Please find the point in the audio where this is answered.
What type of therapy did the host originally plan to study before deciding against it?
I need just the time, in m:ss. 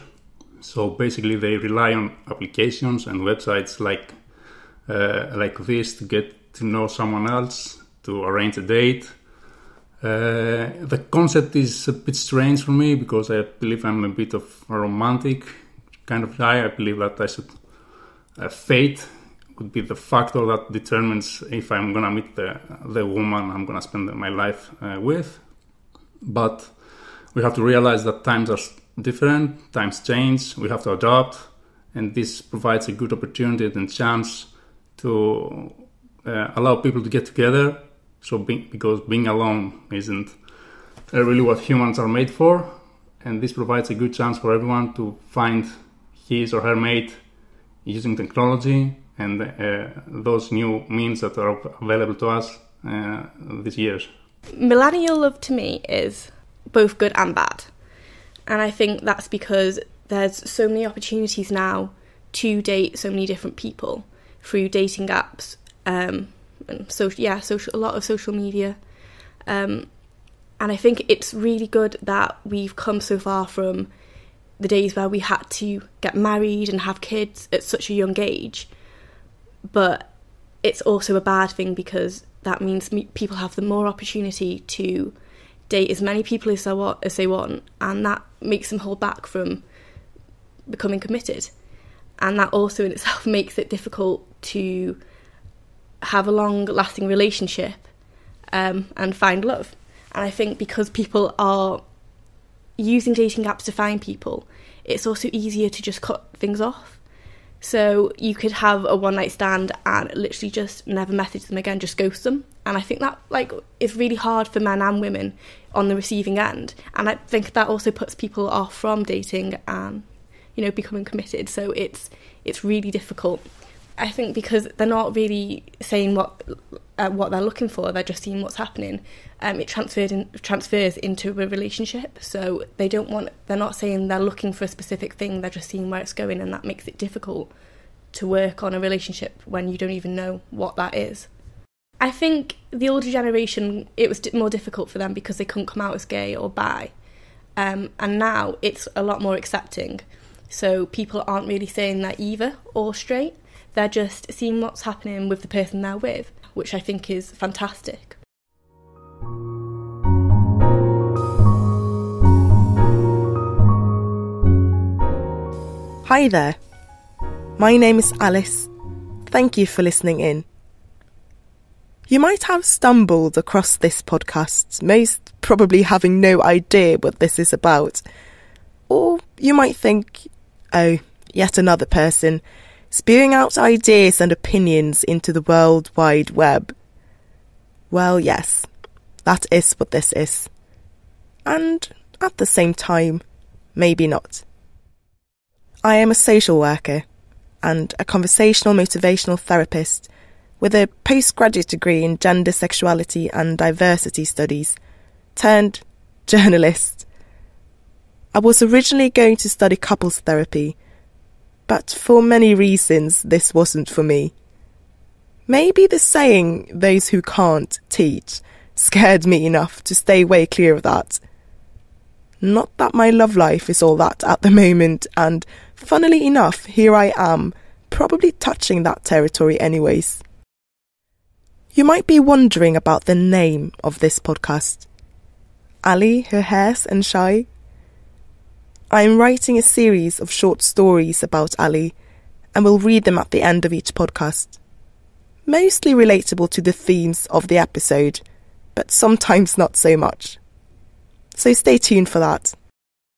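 3:29.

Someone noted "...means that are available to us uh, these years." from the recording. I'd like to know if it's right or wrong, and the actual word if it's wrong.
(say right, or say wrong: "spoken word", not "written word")
right.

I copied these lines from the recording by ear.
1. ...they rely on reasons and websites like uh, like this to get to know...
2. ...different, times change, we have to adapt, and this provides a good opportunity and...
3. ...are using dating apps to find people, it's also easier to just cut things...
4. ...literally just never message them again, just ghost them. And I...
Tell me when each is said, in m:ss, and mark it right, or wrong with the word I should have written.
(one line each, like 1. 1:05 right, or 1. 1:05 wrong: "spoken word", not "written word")
1. 0:01 wrong: "applications", not "reasons"
2. 0:29 right
3. 1:41 right
4. 1:50 right.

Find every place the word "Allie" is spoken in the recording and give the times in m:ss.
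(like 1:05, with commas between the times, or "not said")
3:55, 4:01.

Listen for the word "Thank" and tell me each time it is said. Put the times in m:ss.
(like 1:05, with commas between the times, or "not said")
2:49.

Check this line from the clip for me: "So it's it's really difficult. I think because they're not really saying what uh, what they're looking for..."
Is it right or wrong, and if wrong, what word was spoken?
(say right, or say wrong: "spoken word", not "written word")
right.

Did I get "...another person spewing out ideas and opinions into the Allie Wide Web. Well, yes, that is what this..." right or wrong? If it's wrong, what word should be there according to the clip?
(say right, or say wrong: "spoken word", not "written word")
wrong: "World", not "Allie".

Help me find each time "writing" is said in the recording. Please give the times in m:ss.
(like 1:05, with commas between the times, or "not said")
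3:59.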